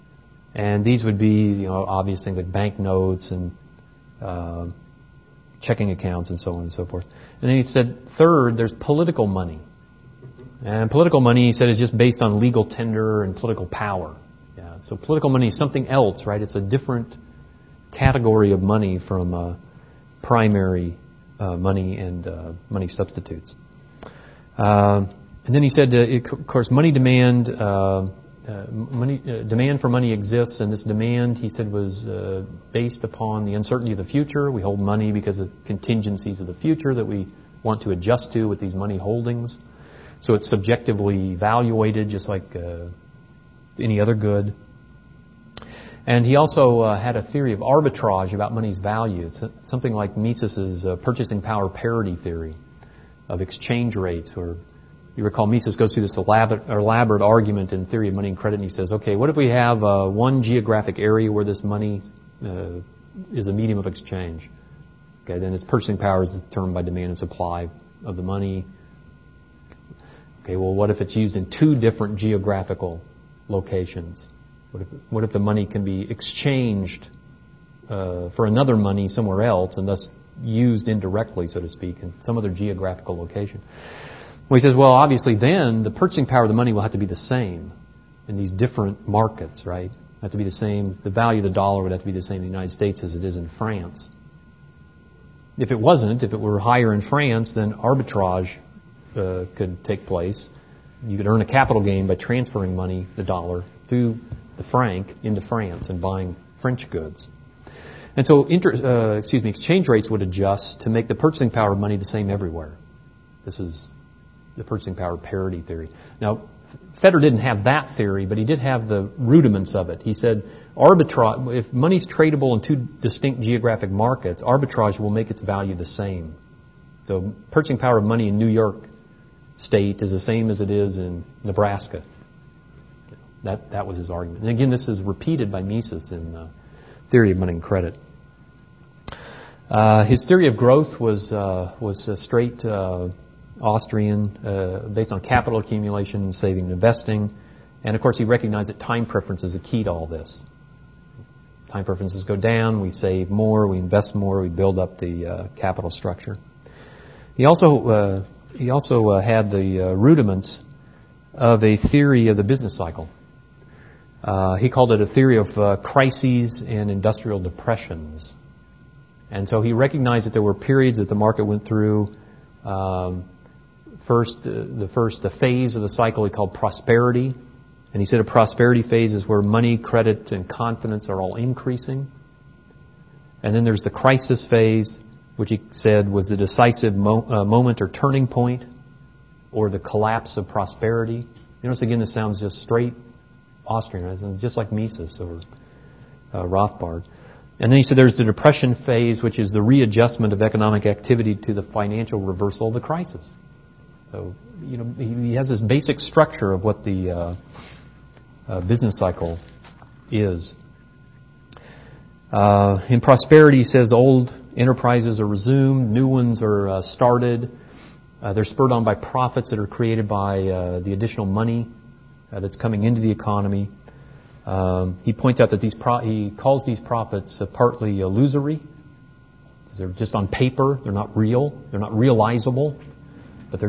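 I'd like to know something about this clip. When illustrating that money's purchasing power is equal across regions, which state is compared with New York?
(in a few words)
Nebraska.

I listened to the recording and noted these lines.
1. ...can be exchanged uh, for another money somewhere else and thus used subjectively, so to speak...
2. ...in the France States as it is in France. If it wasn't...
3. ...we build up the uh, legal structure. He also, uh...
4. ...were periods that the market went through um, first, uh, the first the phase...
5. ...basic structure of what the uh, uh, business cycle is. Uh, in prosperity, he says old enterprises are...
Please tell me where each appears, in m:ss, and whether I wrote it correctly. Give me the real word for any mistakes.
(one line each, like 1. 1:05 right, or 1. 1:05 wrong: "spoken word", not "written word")
1. 1:15 wrong: "indirectly", not "subjectively"
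2. 1:32 wrong: "United", not "France"
3. 2:34 wrong: "capital", not "legal"
4. 2:50 right
5. 3:25 right.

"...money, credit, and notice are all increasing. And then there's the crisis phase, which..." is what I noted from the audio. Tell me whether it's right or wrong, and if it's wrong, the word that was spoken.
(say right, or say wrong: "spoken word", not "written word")
wrong: "confidence", not "notice".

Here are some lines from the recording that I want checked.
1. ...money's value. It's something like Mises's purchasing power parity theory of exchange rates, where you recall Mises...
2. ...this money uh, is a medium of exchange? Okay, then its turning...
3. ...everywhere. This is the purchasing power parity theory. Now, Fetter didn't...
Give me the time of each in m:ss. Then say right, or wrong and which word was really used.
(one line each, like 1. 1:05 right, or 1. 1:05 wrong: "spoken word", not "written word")
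1. 0:48 right
2. 1:01 wrong: "purchasing", not "turning"
3. 1:52 right.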